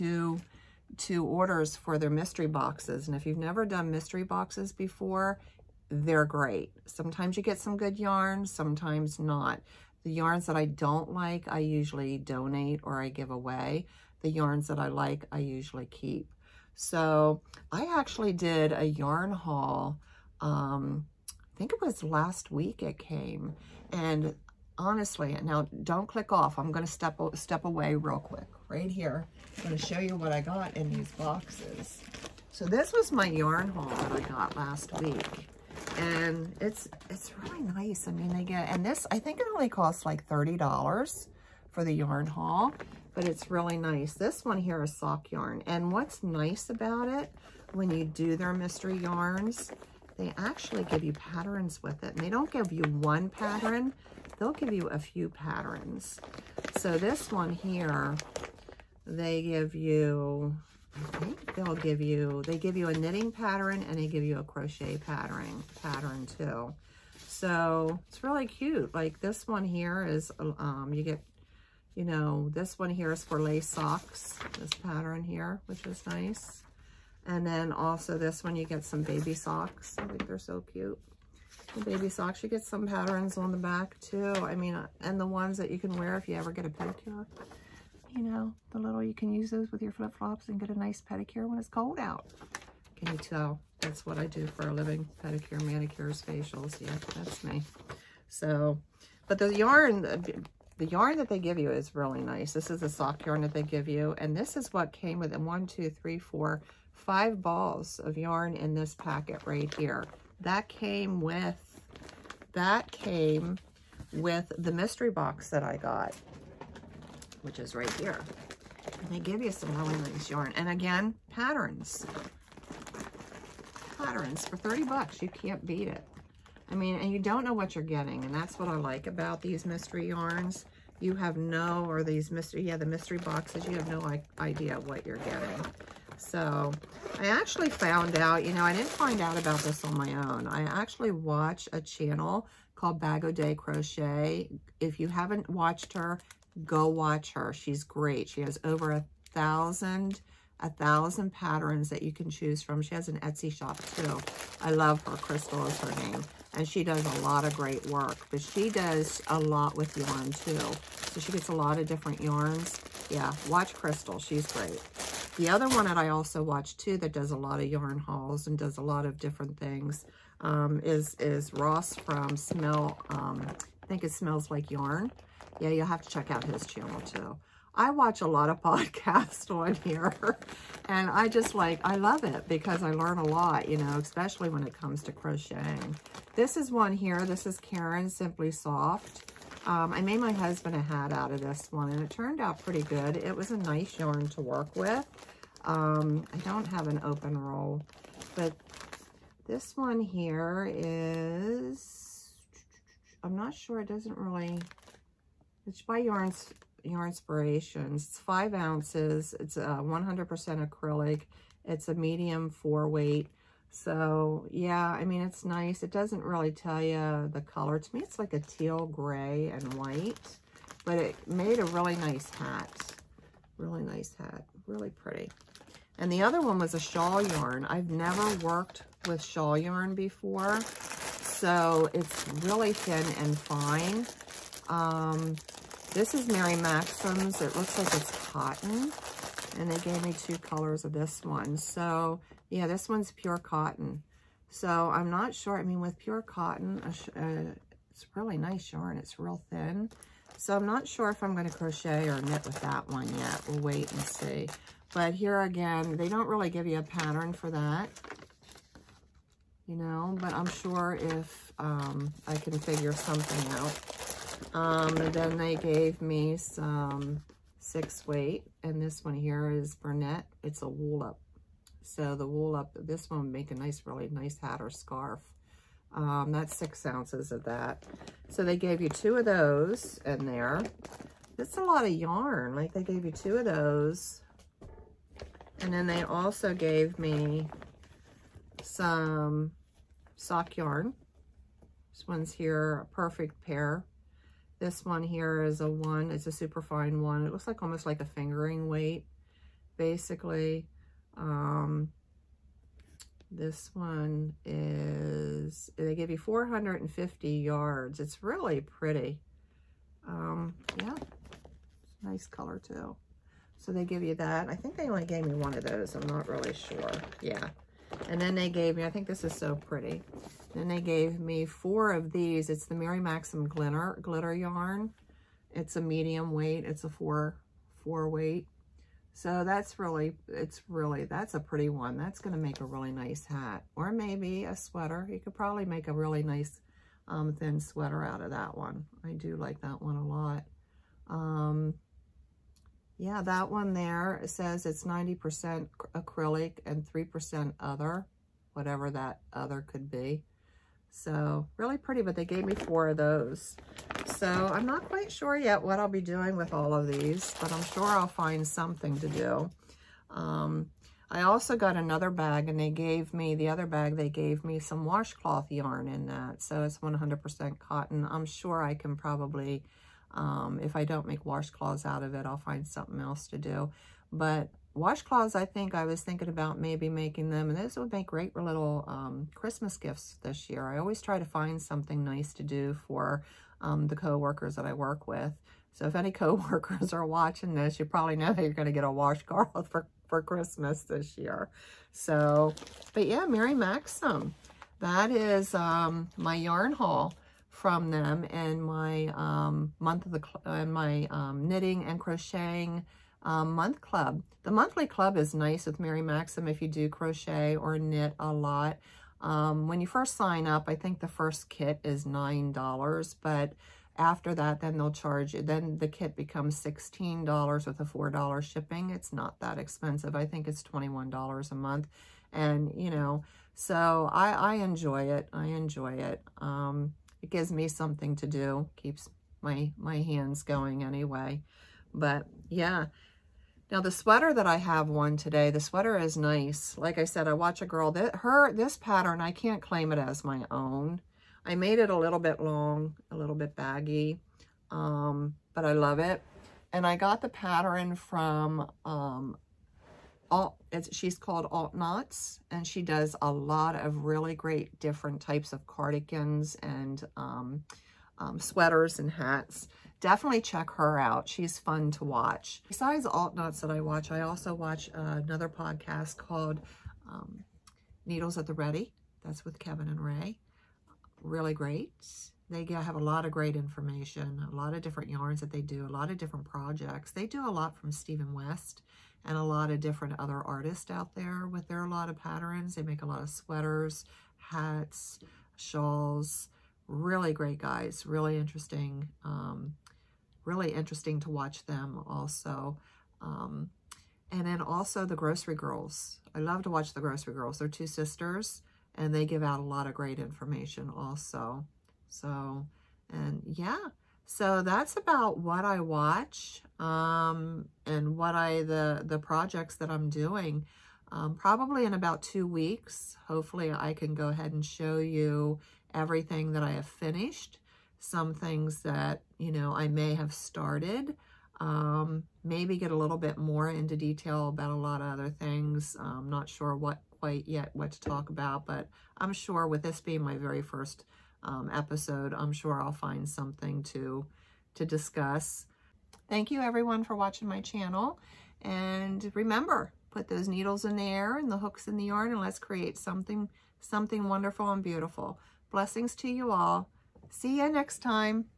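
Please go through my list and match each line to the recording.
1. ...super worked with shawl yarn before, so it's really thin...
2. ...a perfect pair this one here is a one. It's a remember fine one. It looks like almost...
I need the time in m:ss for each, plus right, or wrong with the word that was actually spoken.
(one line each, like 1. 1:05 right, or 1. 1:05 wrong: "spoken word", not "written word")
1. 3:47 wrong: "never", not "super"
2. 4:52 wrong: "super", not "remember".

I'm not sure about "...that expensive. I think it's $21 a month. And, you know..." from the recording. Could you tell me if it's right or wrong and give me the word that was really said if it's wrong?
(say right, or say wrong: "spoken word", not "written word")
right.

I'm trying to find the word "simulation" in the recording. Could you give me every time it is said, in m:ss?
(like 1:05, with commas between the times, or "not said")
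not said.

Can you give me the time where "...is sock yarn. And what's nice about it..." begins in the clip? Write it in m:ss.
0:44.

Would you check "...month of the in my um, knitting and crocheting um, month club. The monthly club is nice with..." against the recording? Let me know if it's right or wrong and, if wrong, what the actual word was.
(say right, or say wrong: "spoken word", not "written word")
right.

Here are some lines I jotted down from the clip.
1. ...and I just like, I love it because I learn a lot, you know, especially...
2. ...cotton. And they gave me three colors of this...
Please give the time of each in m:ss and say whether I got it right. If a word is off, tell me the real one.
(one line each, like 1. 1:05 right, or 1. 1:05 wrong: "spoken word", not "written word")
1. 3:00 right
2. 3:58 wrong: "two", not "three".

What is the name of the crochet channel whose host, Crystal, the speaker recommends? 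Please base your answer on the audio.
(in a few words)
Bag o' Day Crochet.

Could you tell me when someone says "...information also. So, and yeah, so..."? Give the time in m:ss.
8:20.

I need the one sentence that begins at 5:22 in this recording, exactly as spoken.
It's the Mary Maxim Glitter, glitter Yarn.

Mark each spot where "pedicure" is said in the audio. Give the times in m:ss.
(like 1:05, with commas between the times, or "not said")
1:26, 1:31, 1:35.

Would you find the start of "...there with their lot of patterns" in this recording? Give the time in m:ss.
8:01.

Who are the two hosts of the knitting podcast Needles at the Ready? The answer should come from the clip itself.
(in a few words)
Kevin and Ray.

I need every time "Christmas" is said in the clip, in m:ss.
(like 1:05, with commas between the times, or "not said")
6:19, 6:30.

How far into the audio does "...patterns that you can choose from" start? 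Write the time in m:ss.
2:31.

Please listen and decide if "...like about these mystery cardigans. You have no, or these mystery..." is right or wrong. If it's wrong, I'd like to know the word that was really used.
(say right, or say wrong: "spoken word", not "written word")
wrong: "yarns", not "cardigans".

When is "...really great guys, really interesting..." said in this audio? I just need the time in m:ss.
8:06.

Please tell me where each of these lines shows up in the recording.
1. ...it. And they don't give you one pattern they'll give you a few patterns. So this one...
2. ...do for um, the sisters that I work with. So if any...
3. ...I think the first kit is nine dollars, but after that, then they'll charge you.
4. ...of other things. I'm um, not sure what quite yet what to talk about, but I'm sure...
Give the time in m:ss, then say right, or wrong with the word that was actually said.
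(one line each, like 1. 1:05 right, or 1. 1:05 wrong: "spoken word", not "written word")
1. 0:52 right
2. 6:22 wrong: "coworkers", not "sisters"
3. 6:50 right
4. 8:44 right.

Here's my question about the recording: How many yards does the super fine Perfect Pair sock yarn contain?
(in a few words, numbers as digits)
450.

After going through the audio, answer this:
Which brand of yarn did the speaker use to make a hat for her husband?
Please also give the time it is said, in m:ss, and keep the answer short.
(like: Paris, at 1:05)
Caron Simply Soft, at 3:07.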